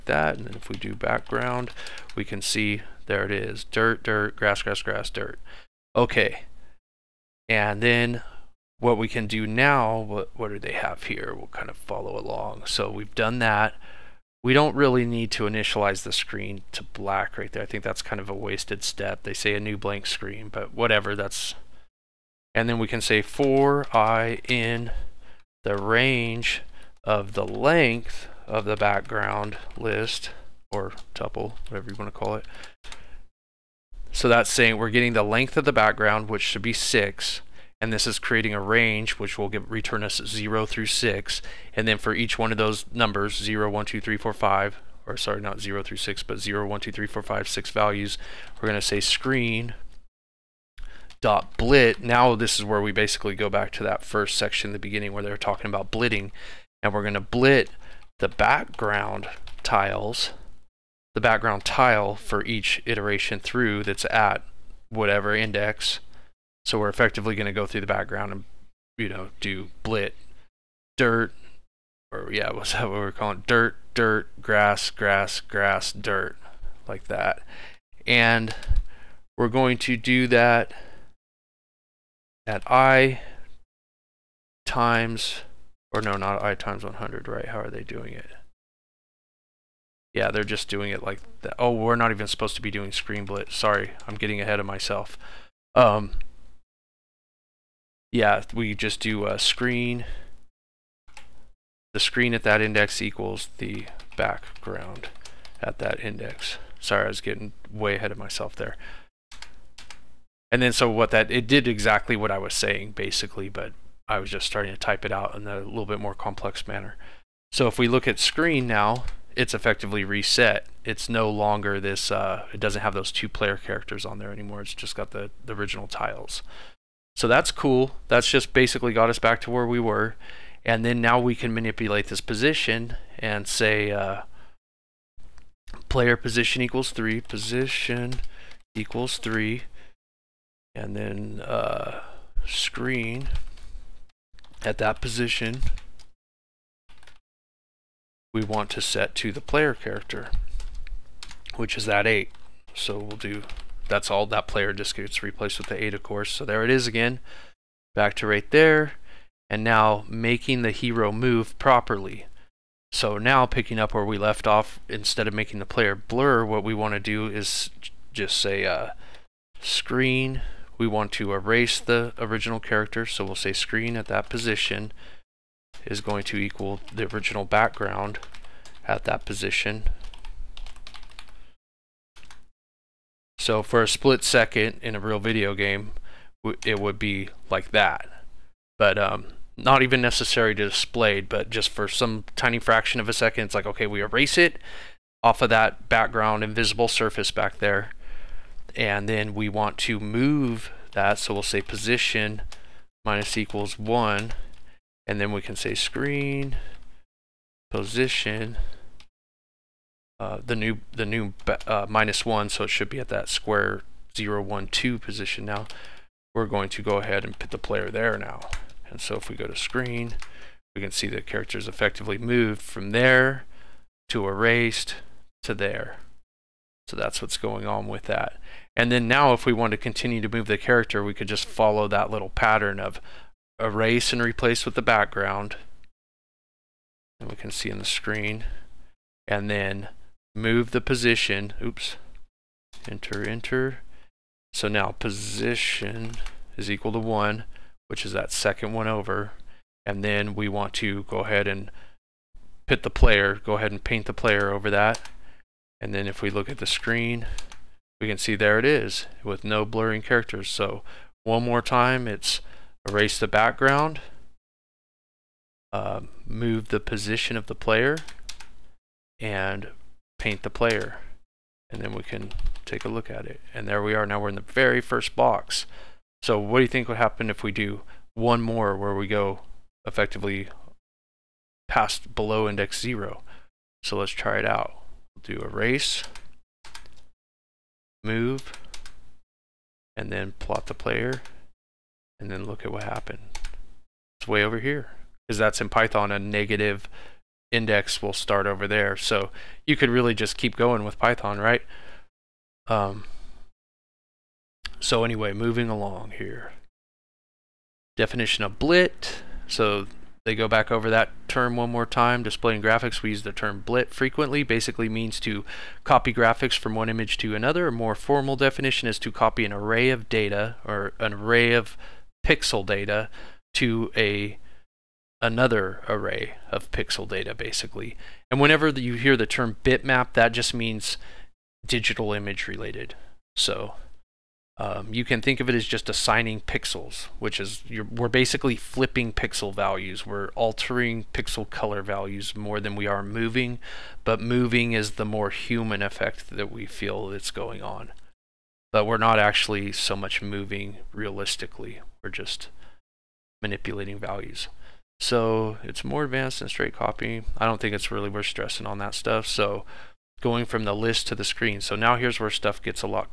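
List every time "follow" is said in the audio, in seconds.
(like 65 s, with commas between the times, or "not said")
11 s, 231 s.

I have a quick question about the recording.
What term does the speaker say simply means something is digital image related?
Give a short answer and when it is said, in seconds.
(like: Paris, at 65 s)
bitmap, at 329 s.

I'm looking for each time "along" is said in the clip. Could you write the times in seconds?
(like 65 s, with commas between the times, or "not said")
12 s, 305 s.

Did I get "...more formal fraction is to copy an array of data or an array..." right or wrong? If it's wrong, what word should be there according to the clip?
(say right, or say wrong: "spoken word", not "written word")
wrong: "definition", not "fraction".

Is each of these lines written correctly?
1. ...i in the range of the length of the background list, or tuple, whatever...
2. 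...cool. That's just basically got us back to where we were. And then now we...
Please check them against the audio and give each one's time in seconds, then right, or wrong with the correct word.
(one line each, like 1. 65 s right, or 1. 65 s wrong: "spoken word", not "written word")
1. 23 s right
2. 127 s right.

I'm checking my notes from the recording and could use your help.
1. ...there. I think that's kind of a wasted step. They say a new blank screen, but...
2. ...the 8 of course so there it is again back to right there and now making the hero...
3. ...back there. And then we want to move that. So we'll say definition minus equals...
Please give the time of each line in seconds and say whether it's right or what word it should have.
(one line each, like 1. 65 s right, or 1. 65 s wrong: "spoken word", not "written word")
1. 17 s right
2. 155 s right
3. 197 s wrong: "position", not "definition".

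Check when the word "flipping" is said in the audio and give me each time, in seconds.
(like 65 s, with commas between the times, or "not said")
338 s.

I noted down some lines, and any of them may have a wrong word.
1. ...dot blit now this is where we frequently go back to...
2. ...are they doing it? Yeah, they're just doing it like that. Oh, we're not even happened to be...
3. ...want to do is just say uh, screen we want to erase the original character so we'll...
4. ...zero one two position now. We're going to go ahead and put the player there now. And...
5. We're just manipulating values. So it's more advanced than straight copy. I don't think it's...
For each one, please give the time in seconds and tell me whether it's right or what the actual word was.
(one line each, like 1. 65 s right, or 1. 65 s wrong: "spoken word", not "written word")
1. 51 s wrong: "basically", not "frequently"
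2. 87 s wrong: "supposed", not "happened"
3. 166 s right
4. 214 s right
5. 352 s right.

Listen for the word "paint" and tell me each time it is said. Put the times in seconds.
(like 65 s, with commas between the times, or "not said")
253 s, 270 s.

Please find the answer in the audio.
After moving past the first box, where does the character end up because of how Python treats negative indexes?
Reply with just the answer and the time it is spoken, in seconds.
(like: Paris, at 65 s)
way over here, at 294 s.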